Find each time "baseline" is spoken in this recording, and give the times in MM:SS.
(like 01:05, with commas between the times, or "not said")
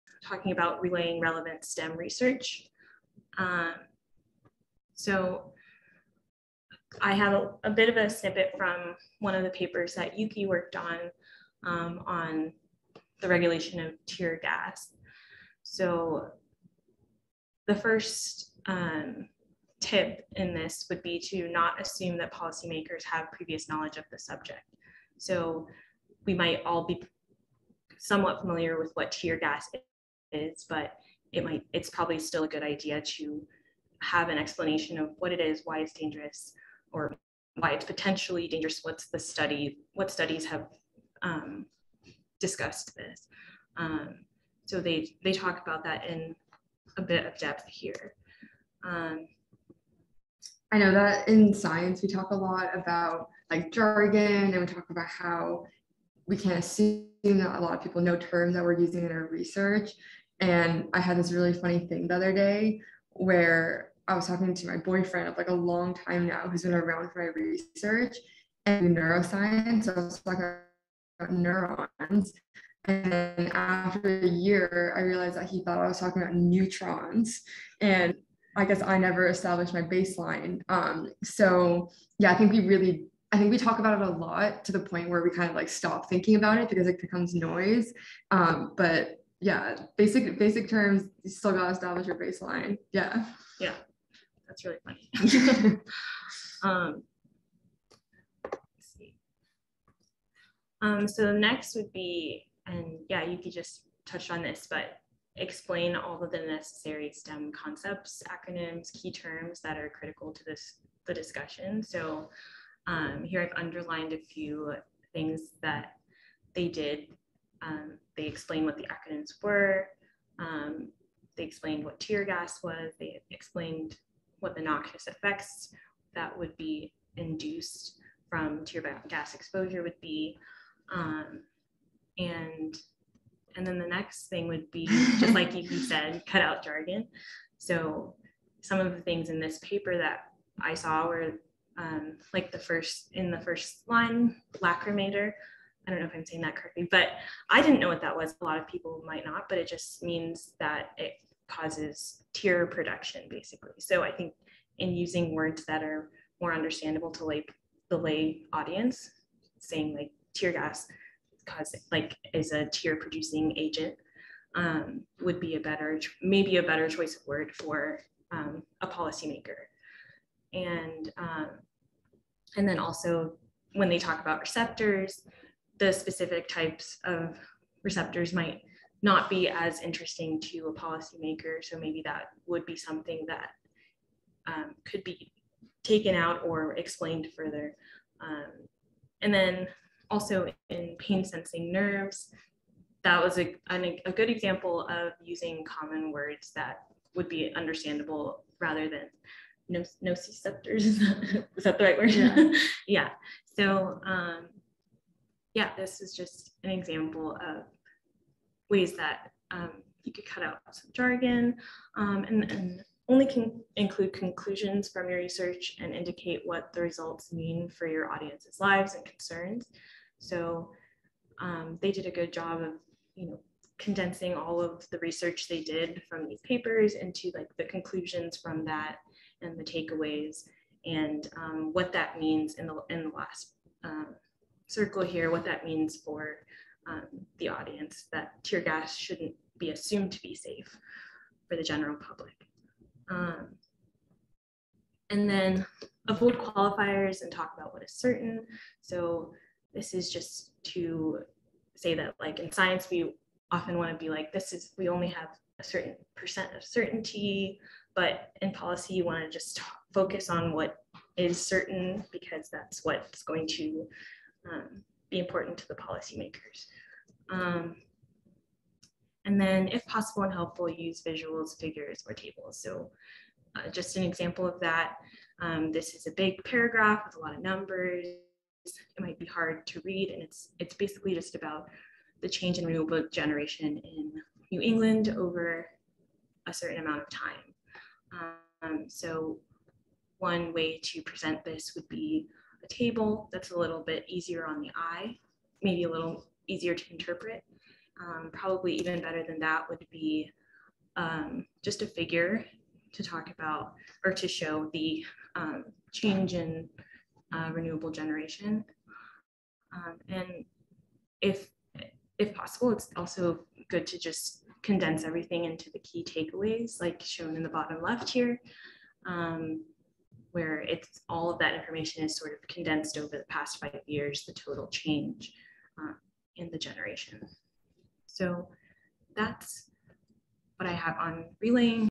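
01:19, 01:32.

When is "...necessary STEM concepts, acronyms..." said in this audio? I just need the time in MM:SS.
01:46.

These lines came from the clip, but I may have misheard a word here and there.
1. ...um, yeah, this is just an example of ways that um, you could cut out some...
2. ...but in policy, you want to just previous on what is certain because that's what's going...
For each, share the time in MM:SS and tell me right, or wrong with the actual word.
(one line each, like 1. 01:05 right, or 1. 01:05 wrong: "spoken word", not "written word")
1. 03:24 right
2. 04:17 wrong: "focus", not "previous".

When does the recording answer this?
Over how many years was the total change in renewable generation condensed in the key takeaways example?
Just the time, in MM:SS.
05:23.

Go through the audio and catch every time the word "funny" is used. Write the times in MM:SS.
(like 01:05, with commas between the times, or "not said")
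01:01, 01:34.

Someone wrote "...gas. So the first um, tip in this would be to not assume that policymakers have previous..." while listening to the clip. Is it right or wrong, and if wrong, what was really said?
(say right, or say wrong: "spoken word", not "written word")
right.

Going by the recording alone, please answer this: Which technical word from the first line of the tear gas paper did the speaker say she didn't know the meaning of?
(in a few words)
lacrimator.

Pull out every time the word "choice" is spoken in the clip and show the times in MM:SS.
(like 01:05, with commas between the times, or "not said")
02:46.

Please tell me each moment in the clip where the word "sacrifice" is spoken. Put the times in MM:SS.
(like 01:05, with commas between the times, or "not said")
not said.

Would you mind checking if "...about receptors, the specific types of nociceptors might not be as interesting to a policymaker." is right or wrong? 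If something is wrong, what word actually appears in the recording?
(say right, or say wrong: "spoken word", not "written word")
wrong: "receptors", not "nociceptors".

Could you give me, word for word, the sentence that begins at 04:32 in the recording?
So uh, just an example of that, um, this is a big paragraph with a lot of numbers.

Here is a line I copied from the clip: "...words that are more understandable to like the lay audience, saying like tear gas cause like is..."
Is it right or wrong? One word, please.
right.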